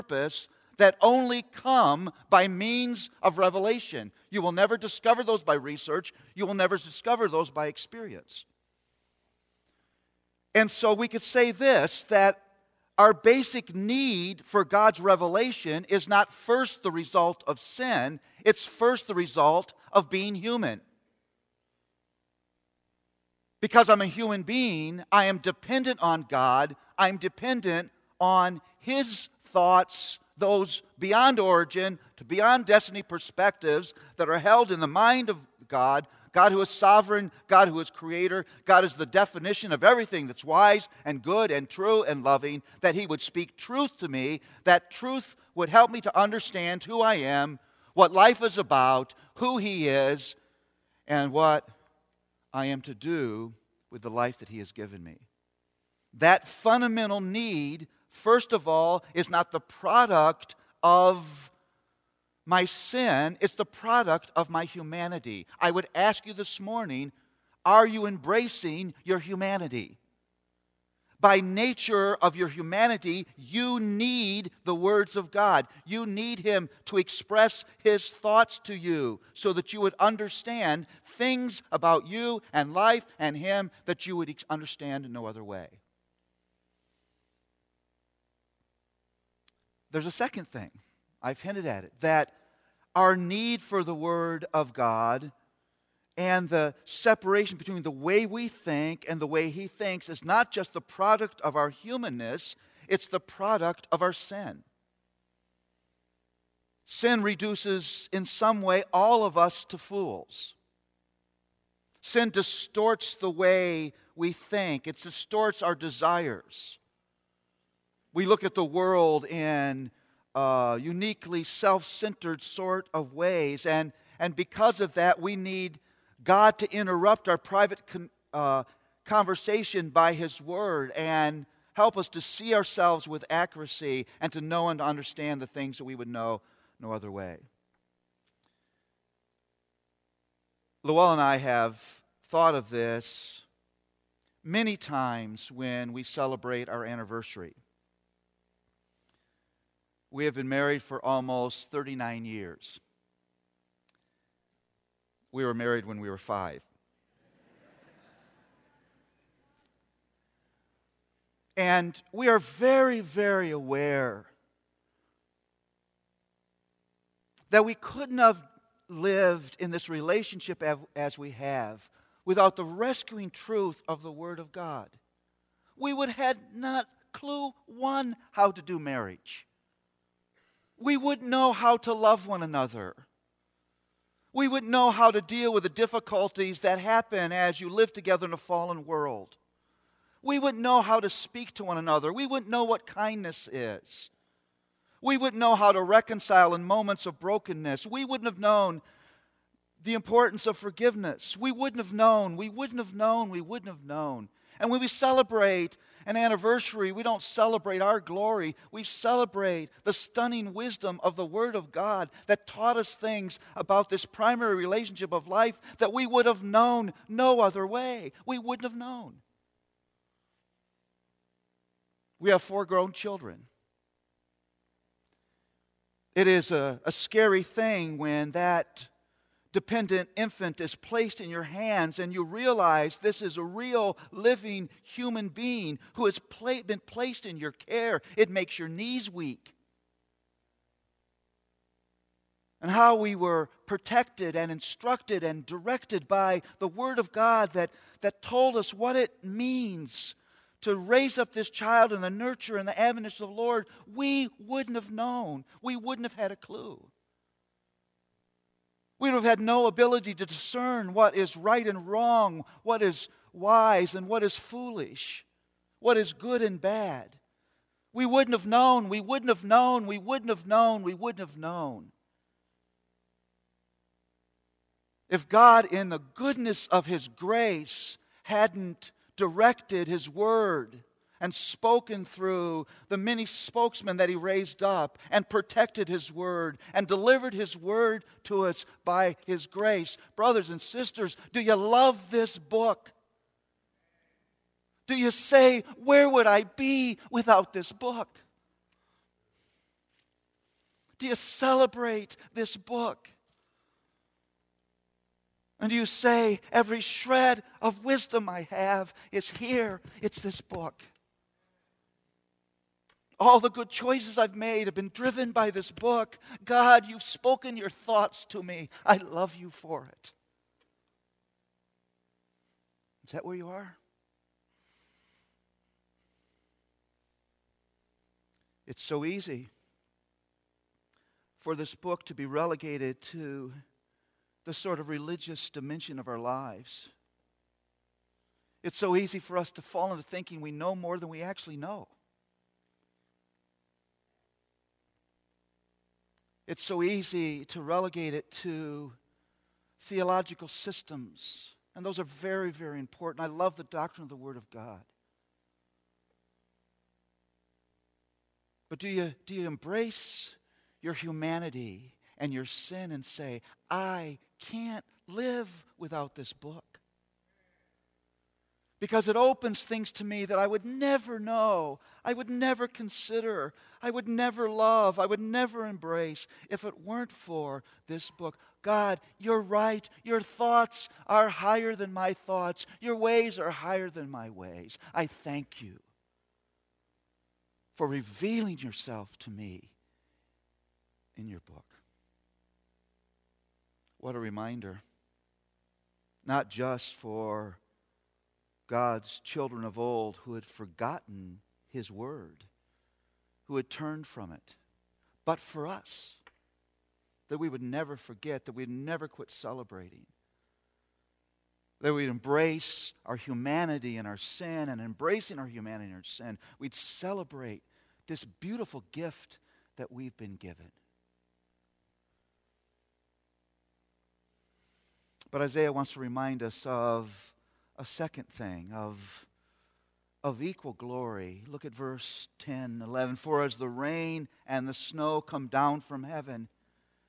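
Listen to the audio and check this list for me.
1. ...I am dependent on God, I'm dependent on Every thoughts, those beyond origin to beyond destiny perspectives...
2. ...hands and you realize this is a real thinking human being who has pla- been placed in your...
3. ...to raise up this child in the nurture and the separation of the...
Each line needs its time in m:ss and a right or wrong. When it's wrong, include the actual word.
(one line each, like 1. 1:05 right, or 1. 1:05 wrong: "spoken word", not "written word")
1. 0:25 wrong: "His", not "Every"
2. 3:51 wrong: "living", not "thinking"
3. 4:10 wrong: "admonition", not "separation".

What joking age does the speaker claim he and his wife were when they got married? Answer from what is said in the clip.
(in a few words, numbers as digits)
5.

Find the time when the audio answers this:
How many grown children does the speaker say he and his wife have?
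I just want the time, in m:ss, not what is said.
3:42.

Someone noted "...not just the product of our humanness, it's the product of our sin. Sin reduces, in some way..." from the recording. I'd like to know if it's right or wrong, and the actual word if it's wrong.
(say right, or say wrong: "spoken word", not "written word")
right.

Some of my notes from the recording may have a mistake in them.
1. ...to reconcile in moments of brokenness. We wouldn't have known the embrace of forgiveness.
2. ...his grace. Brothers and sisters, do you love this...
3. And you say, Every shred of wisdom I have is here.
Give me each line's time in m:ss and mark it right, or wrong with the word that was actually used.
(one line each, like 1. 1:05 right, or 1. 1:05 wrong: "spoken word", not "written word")
1. 3:15 wrong: "importance", not "embrace"
2. 4:49 right
3. 5:05 right.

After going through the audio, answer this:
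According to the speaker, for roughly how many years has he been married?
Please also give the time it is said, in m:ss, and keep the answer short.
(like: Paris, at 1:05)
39, at 2:31.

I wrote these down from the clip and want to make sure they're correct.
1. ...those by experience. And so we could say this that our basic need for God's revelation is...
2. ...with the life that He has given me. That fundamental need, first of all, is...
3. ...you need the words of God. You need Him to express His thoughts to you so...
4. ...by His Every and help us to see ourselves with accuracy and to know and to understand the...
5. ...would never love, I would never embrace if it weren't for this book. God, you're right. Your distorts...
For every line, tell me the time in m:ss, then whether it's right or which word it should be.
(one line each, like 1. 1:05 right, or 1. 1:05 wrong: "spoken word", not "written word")
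1. 0:07 right
2. 0:53 right
3. 1:13 right
4. 2:09 wrong: "Word", not "Every"
5. 6:13 wrong: "thoughts", not "distorts".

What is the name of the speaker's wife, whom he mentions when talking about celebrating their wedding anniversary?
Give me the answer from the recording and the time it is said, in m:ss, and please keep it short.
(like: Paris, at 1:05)
Luella, at 2:20.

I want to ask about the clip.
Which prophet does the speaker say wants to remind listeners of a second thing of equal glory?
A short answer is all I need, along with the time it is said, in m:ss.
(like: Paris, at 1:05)
Isaiah, at 7:05.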